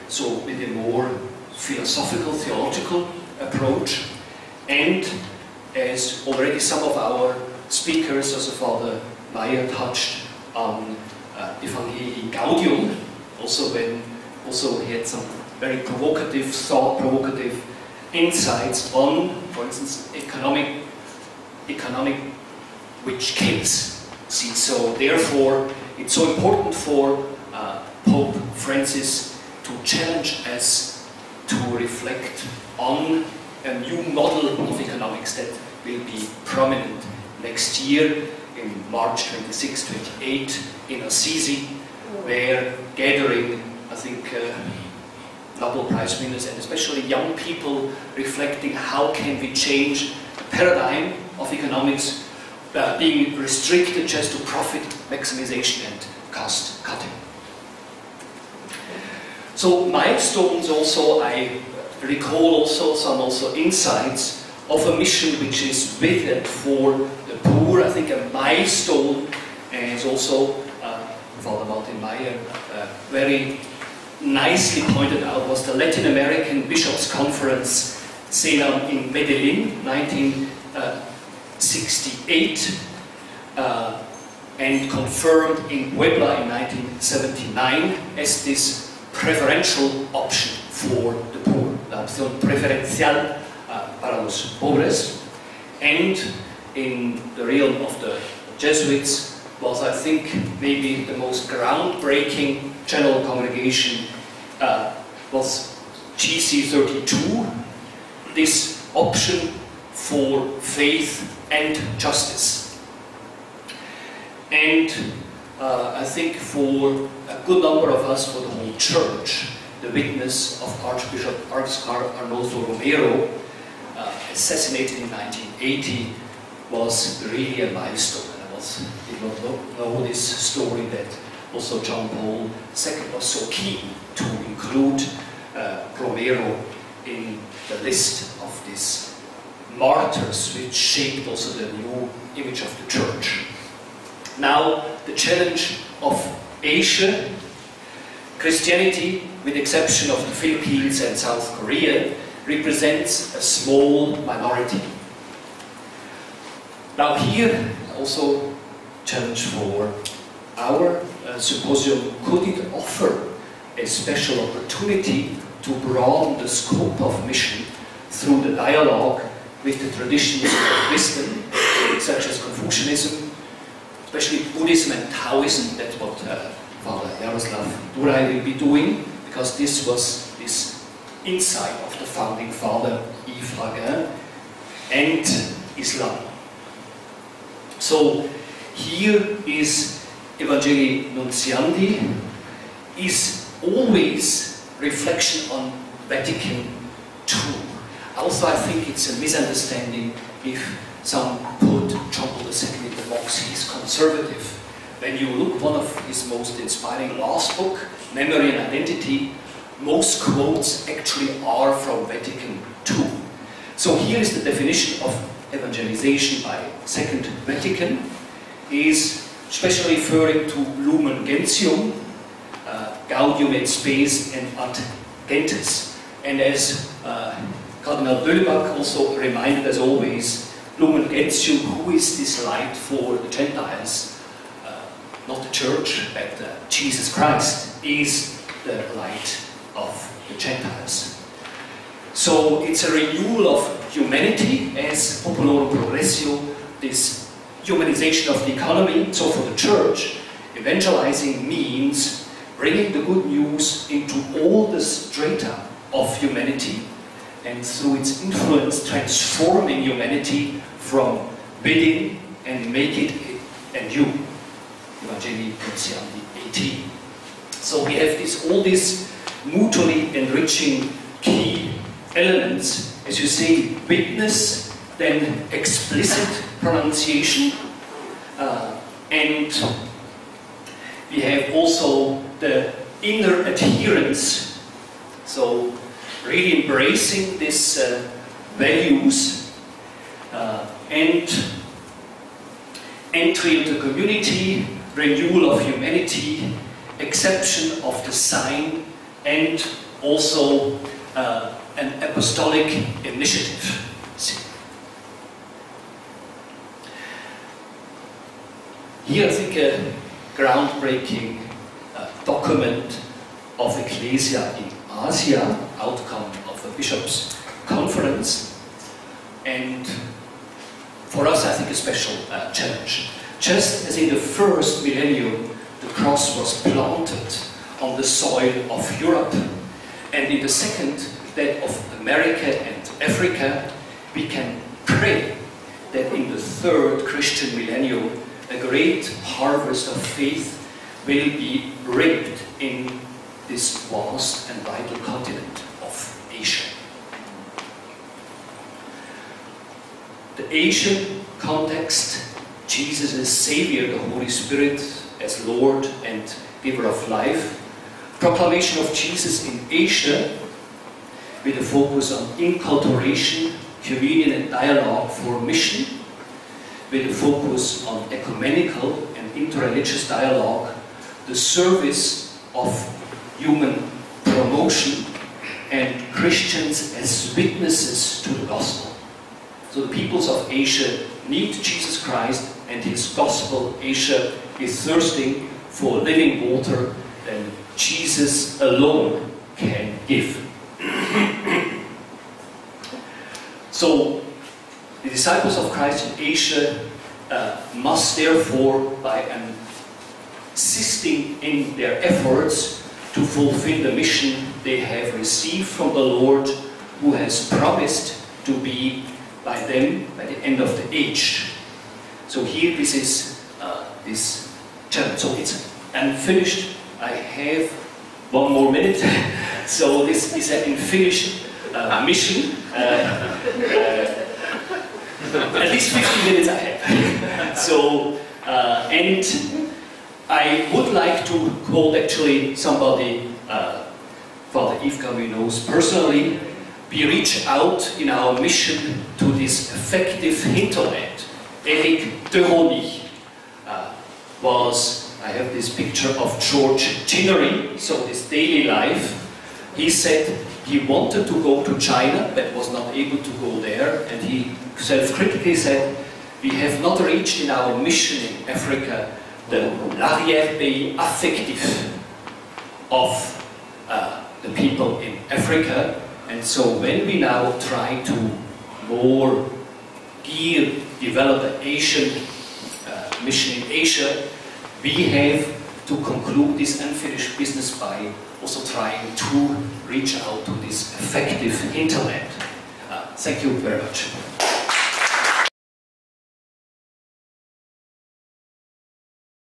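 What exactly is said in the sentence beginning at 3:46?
And as uh, Cardinal Böllbach also reminded us always, Lumen Gentium, who is this light for the Gentiles?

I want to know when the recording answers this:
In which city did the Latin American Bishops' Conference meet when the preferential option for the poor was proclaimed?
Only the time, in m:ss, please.
1:19.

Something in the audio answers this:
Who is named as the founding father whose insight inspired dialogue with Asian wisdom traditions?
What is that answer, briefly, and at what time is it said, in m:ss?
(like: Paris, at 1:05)
Yves Raguin, at 3:03.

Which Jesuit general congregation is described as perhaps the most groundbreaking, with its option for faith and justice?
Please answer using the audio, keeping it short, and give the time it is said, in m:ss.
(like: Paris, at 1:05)
GC32, at 1:46.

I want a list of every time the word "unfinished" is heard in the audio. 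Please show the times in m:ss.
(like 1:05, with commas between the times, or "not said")
6:55, 7:00, 7:56.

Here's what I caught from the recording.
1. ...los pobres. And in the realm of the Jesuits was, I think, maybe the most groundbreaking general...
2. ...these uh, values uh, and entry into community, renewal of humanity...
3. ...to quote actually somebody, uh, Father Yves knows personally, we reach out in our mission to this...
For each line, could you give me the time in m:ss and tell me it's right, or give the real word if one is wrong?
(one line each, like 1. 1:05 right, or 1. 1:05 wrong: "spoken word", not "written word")
1. 1:34 right
2. 4:47 right
3. 7:11 right.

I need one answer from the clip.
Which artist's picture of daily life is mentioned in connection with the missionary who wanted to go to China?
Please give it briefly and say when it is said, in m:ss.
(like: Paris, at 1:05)
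George Chinnery, at 7:26.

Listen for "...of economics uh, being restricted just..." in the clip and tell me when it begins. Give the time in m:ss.
0:51.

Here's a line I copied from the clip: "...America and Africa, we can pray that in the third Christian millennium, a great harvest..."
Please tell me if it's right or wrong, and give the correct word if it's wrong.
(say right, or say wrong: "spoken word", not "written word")
right.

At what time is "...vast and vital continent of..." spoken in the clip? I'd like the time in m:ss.
5:43.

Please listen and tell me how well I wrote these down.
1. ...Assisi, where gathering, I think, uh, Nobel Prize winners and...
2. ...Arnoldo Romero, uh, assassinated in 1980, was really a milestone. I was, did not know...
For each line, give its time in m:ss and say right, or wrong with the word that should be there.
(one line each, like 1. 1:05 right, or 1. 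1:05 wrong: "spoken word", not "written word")
1. 0:41 right
2. 2:01 right.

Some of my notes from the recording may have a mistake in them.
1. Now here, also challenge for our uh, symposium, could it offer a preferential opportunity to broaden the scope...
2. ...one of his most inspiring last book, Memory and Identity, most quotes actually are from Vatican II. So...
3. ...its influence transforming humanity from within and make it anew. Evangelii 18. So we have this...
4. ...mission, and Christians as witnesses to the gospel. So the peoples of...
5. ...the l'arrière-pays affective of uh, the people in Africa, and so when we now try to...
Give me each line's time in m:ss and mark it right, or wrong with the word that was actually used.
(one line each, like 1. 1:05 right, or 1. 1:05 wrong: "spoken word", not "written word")
1. 2:36 wrong: "special", not "preferential"
2. 3:25 right
3. 4:17 right
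4. 6:14 wrong: "promotion", not "mission"
5. 7:39 right.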